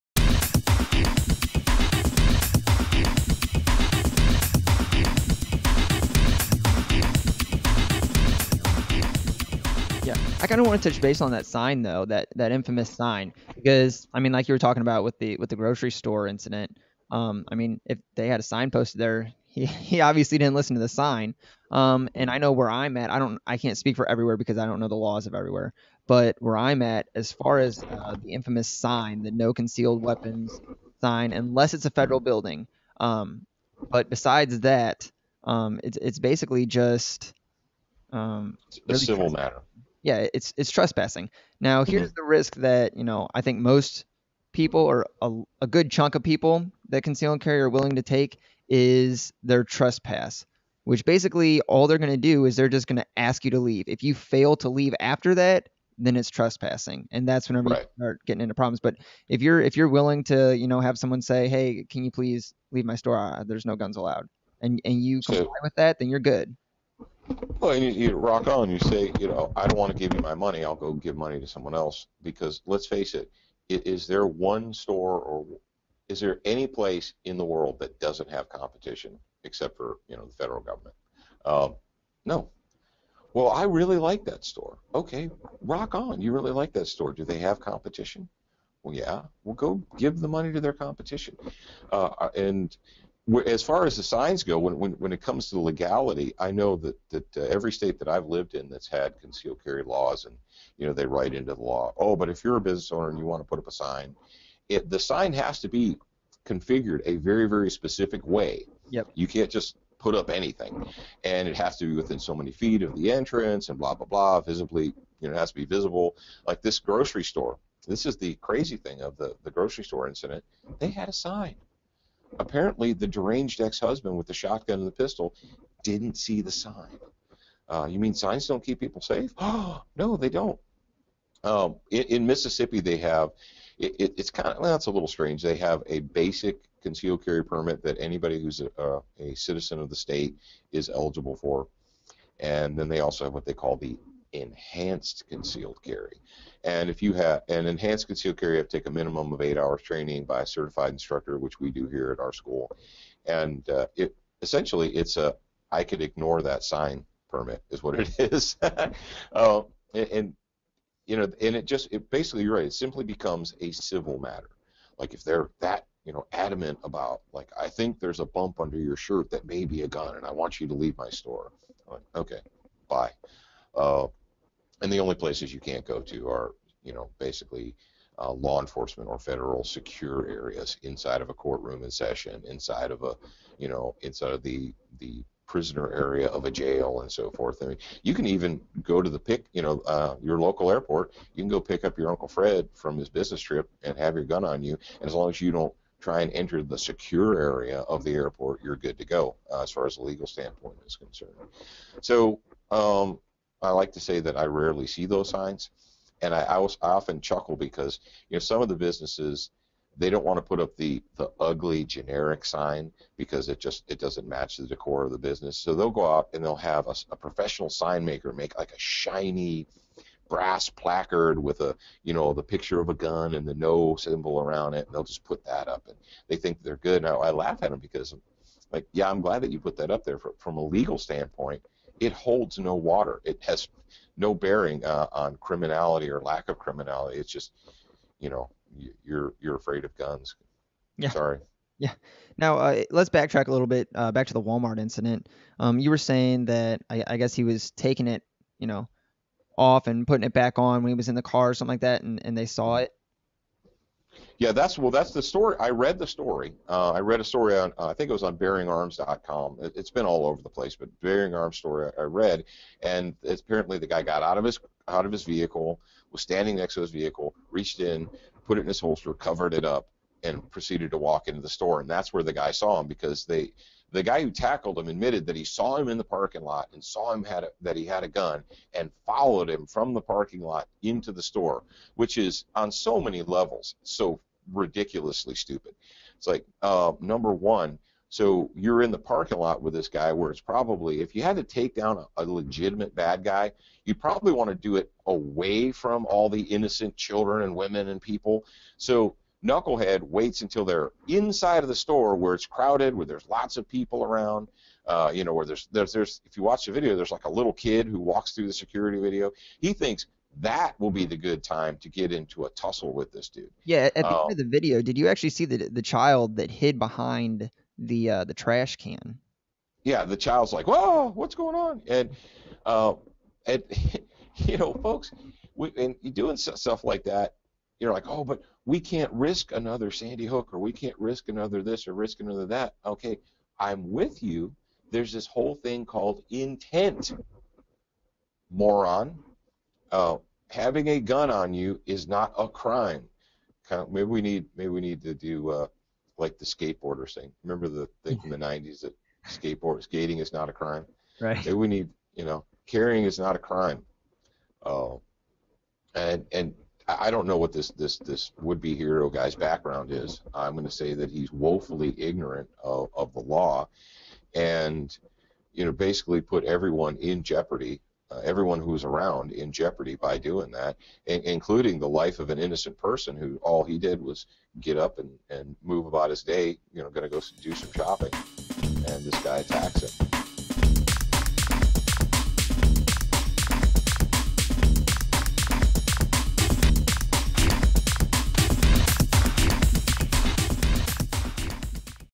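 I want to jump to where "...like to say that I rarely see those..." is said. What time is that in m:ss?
3:23.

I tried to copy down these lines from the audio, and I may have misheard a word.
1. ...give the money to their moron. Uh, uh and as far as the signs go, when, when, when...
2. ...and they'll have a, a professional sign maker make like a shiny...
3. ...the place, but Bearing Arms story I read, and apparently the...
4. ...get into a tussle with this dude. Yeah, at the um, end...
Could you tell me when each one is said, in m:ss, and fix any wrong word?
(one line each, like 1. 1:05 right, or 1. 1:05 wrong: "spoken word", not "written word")
1. 1:29 wrong: "competition", not "moron"
2. 3:36 right
3. 4:20 right
4. 5:11 right.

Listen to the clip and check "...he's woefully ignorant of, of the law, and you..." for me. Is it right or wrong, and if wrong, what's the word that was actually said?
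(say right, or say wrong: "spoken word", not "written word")
right.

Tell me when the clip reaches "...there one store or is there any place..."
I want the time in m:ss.
1:14.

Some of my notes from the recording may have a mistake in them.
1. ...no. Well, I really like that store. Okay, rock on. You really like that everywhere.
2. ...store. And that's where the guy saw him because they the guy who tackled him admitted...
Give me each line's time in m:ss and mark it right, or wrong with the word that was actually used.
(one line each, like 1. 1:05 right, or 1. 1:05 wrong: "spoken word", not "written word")
1. 1:22 wrong: "store", not "everywhere"
2. 4:31 right.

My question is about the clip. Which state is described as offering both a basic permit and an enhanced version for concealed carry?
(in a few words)
Mississippi.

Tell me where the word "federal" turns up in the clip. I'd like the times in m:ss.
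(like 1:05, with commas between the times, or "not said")
0:31, 1:20, 2:59.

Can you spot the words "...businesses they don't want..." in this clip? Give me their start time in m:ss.
3:28.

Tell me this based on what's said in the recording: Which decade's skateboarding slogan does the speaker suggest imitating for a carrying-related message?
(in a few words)
The '90s.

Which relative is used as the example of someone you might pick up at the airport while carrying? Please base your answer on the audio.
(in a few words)
Uncle Fred.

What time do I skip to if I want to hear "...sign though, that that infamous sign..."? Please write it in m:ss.
0:11.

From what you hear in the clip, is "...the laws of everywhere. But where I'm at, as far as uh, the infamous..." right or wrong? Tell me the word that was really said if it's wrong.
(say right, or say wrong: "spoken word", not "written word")
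right.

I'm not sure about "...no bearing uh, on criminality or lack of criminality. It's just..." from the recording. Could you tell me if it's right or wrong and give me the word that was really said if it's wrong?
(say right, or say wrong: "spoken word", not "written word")
right.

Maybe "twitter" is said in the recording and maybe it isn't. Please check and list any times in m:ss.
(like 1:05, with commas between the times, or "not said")
not said.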